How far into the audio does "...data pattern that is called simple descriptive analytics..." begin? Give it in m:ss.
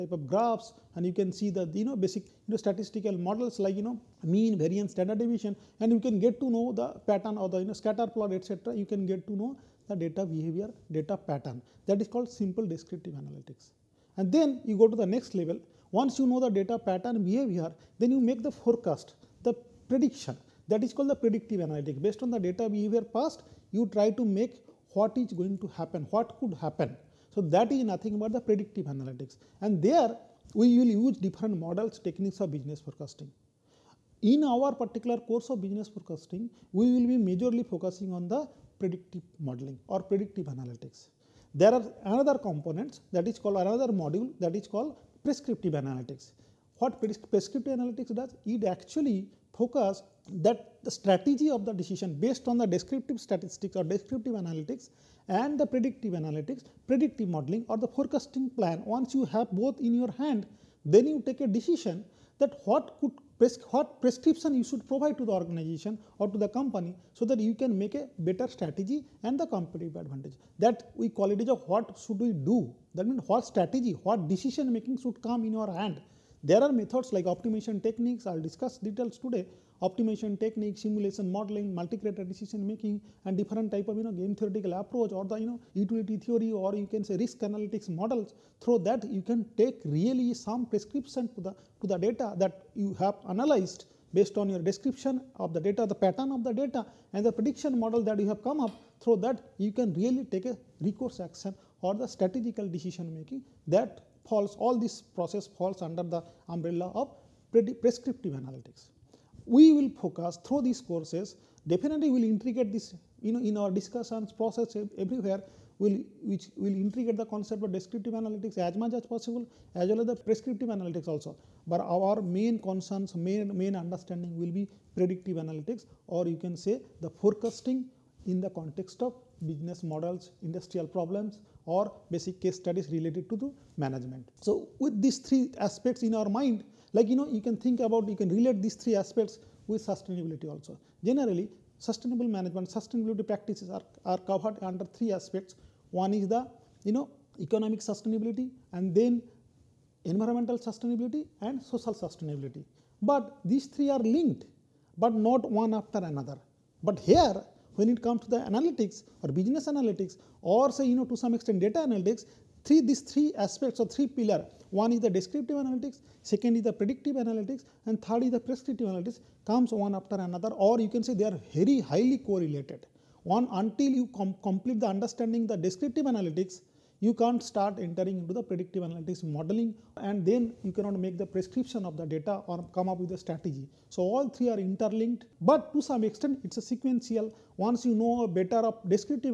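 0:10.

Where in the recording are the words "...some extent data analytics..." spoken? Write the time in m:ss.
2:41.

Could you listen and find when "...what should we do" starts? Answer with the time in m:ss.
1:11.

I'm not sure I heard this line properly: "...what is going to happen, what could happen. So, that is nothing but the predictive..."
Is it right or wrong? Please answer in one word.
right.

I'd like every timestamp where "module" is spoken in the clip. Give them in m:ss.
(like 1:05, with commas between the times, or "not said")
0:43.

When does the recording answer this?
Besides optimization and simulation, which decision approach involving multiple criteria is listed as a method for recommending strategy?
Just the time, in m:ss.
1:21.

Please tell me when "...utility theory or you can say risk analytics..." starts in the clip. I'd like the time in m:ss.
1:25.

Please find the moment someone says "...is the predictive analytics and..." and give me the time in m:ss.
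2:46.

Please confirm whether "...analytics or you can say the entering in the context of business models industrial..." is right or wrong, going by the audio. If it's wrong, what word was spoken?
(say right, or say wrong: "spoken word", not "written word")
wrong: "forecasting", not "entering".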